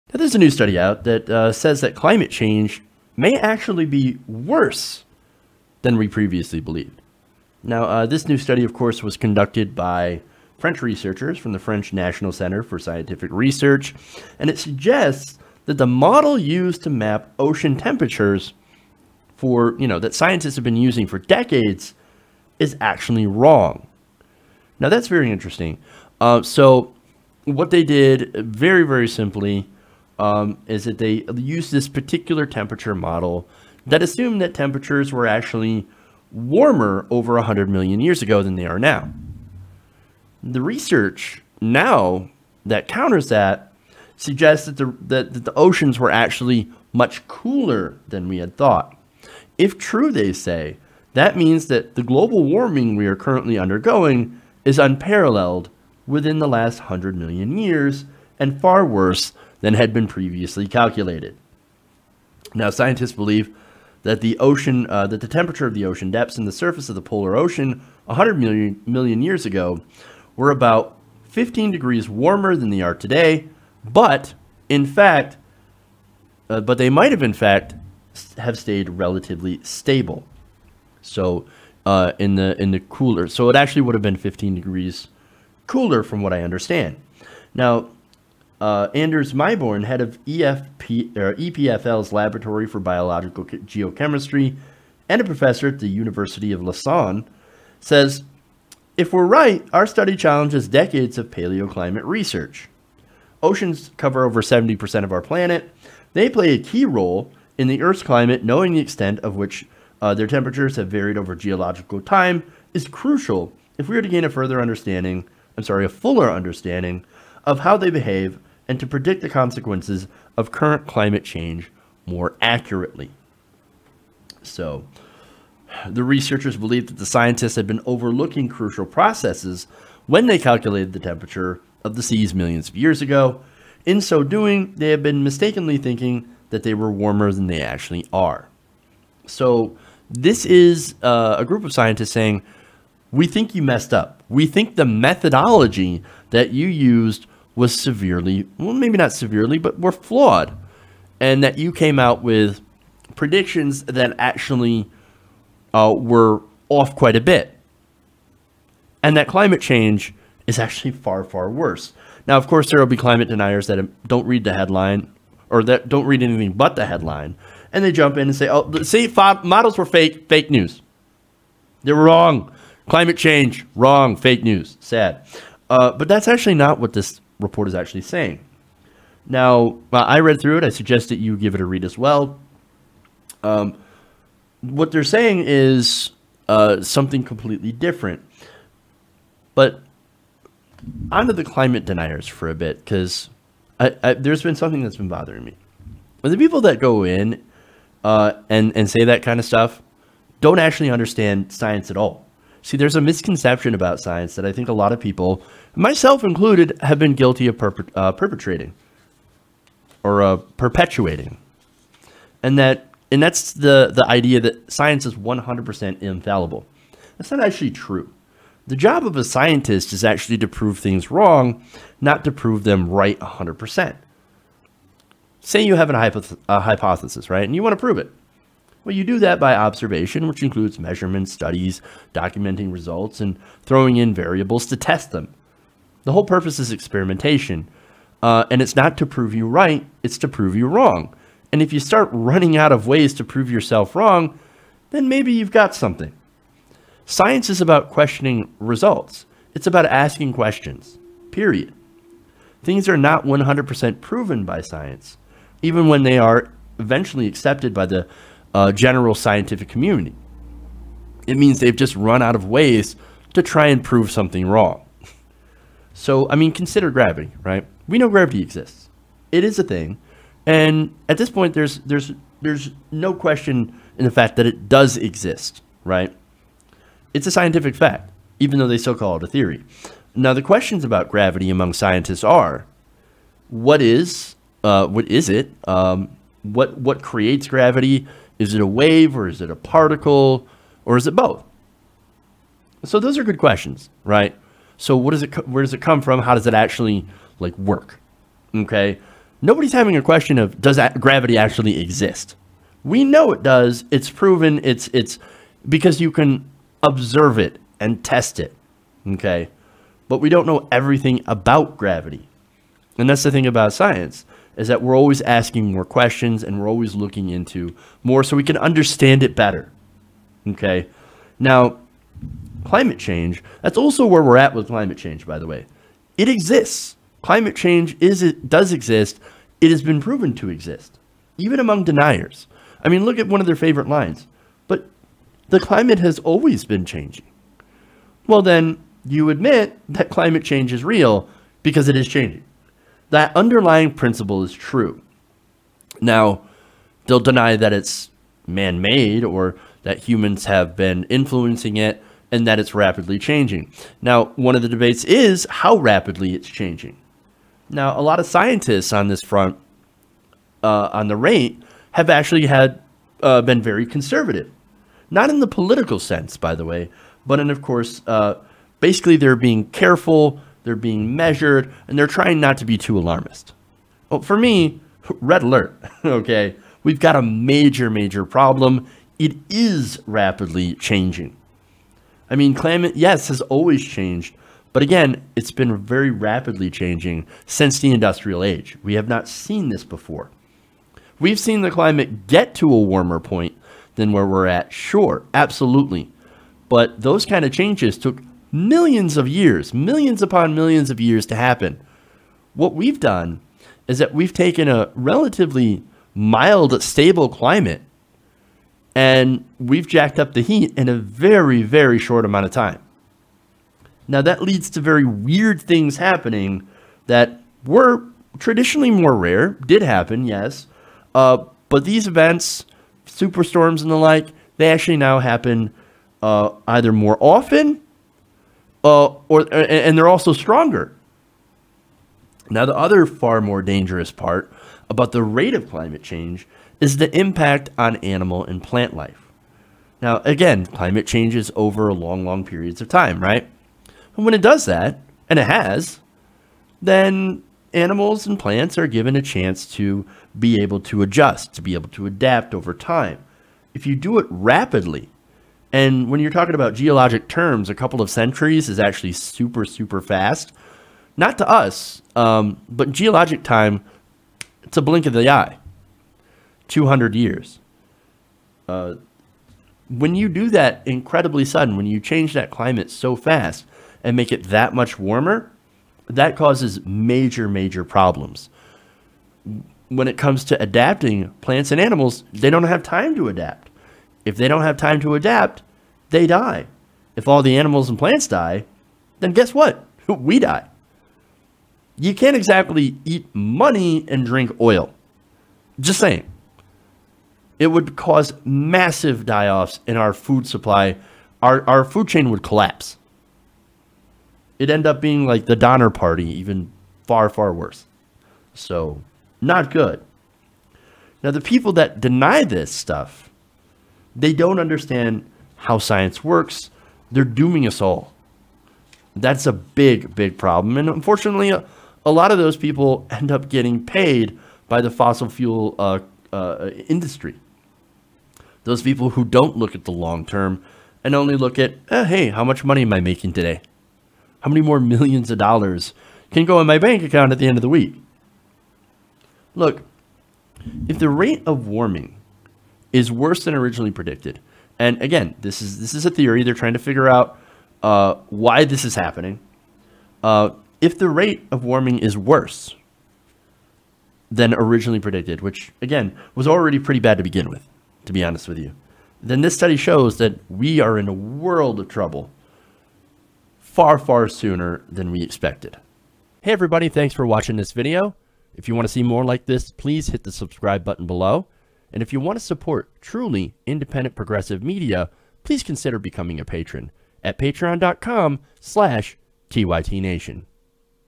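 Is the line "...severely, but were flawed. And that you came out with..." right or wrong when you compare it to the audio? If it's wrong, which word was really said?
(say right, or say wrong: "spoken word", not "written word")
right.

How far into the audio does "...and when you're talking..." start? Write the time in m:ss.
7:35.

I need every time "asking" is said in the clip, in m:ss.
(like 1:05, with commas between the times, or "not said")
4:09, 5:15.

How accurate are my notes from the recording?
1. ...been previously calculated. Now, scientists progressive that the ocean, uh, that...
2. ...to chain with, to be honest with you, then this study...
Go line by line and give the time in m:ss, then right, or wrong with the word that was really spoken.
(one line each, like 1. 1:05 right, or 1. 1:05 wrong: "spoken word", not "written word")
1. 0:59 wrong: "believe", not "progressive"
2. 9:17 wrong: "begin", not "chain".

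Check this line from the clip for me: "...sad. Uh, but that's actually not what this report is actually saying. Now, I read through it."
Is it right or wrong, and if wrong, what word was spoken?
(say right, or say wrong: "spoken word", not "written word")
right.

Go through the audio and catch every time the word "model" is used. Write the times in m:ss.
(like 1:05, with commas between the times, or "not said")
0:15, 0:32, 2:49.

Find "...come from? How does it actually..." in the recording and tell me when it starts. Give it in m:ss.
4:55.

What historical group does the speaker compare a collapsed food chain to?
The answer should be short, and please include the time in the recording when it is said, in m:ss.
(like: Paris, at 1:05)
Donner Party, at 8:25.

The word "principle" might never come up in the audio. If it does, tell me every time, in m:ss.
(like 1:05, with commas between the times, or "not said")
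5:43.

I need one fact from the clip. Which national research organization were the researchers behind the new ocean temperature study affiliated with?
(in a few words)
French National Center for Scientific Research.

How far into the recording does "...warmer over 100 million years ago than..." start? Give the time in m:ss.
0:36.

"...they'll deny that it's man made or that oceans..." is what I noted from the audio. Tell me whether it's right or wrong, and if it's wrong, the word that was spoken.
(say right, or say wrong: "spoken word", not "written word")
wrong: "humans", not "oceans".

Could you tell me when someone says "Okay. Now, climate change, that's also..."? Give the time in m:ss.
5:20.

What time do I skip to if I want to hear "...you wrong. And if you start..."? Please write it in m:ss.
4:00.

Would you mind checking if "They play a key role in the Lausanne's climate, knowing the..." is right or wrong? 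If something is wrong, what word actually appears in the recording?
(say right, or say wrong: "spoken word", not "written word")
wrong: "Earth", not "Lausanne".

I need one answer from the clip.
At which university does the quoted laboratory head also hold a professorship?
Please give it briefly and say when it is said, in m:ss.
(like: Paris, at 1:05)
University of Lausanne, at 1:35.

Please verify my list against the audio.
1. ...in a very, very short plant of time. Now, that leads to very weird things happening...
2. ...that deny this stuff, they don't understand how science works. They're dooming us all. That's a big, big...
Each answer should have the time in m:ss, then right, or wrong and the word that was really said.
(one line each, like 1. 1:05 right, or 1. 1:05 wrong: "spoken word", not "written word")
1. 6:50 wrong: "amount", not "plant"
2. 8:31 right.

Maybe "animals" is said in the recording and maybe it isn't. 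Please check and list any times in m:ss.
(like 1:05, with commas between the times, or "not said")
7:17, 7:27, 8:01, 8:07.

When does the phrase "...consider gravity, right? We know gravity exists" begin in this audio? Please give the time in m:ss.
4:26.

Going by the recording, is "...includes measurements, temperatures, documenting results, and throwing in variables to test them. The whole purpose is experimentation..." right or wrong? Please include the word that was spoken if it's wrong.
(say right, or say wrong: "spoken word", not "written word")
wrong: "studies", not "temperatures".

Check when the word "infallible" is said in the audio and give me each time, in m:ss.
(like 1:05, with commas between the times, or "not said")
3:36.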